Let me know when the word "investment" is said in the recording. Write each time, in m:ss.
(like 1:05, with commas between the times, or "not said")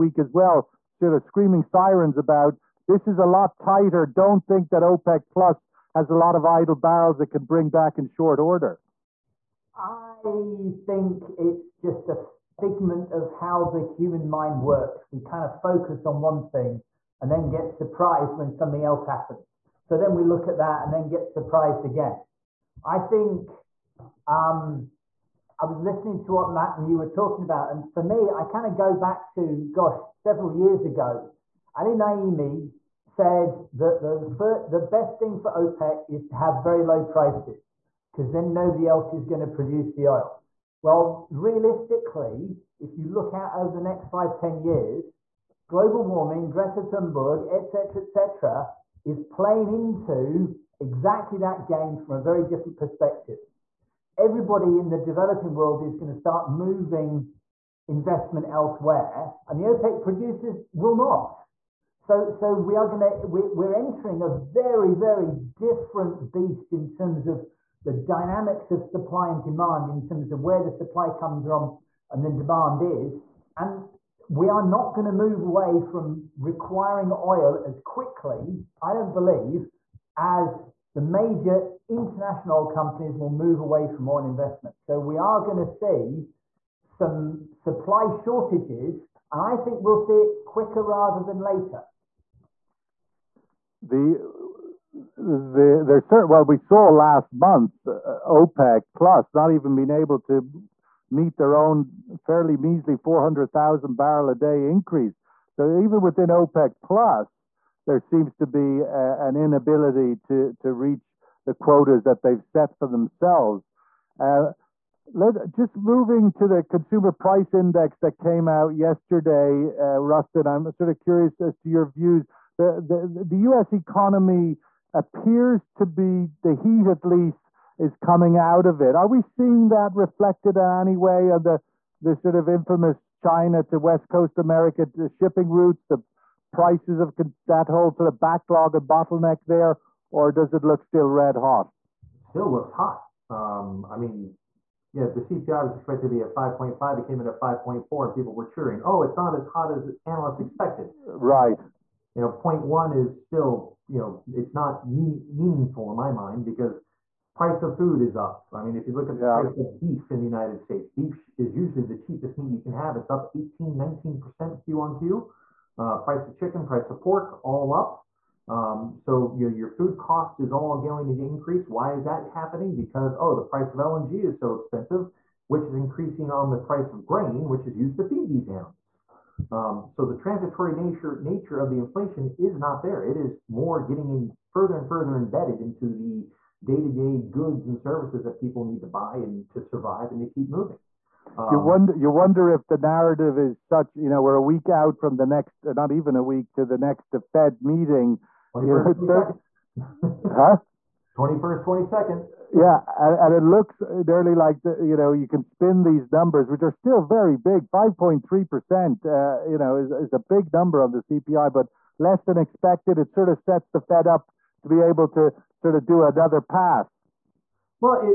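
0:57, 1:24.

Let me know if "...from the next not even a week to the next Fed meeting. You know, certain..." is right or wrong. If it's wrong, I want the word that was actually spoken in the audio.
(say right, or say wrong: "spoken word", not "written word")
right.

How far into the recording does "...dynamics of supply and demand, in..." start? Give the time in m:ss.
1:07.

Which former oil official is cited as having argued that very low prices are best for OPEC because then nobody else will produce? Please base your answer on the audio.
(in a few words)
Ali Naimi.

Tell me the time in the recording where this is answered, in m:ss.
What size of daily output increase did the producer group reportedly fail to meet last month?
1:42.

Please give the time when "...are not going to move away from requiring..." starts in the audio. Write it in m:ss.
1:14.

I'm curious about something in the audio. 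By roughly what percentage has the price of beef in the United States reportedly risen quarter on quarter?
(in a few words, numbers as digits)
18-19%.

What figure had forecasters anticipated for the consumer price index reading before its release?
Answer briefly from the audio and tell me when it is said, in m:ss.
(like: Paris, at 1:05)
5.5, at 2:26.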